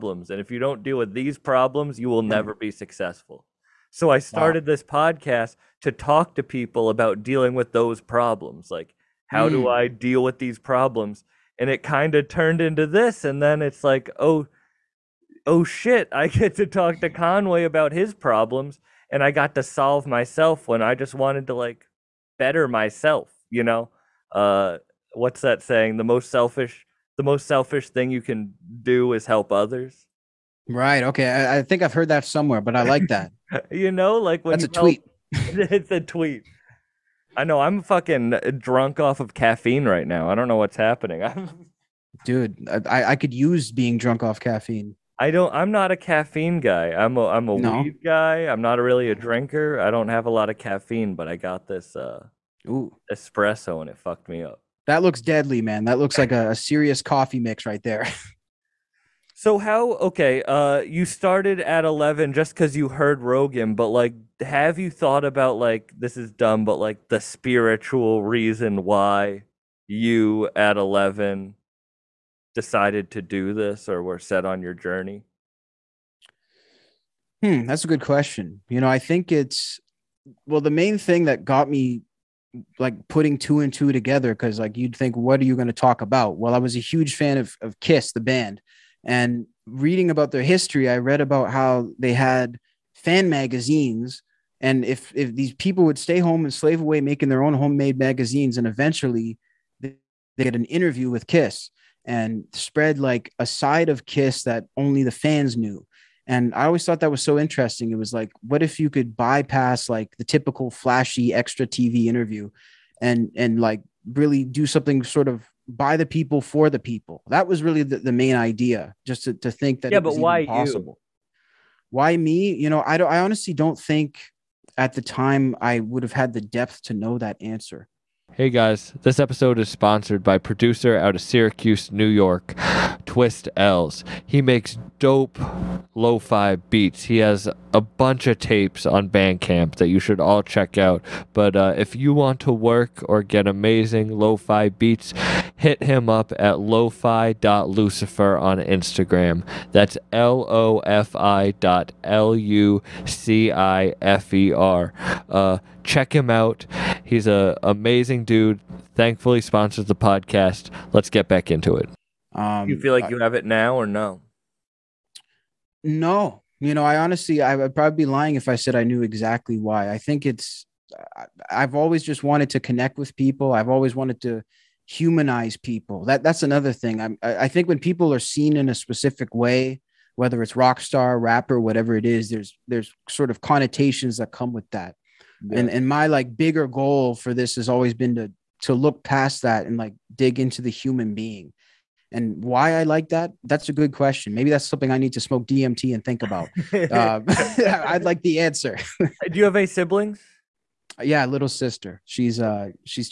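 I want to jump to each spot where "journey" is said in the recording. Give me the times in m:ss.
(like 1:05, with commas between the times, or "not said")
1:14.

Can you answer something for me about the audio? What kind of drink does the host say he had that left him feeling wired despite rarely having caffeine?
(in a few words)
Espresso.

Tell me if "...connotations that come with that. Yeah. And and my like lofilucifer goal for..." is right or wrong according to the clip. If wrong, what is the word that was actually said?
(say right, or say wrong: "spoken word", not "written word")
wrong: "bigger", not "lofilucifer".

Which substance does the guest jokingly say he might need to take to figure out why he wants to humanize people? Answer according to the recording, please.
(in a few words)
DMT.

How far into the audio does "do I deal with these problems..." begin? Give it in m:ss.
0:09.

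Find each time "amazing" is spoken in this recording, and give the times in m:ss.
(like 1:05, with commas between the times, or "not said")
2:23, 2:37.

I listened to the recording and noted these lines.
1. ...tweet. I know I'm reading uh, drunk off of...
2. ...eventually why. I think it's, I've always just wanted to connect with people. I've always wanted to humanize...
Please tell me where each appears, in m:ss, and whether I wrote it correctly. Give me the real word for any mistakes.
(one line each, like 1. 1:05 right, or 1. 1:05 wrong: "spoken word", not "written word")
1. 0:36 wrong: "fucking", not "reading"
2. 2:49 wrong: "exactly", not "eventually".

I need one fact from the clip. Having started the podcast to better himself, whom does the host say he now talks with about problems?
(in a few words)
Conway.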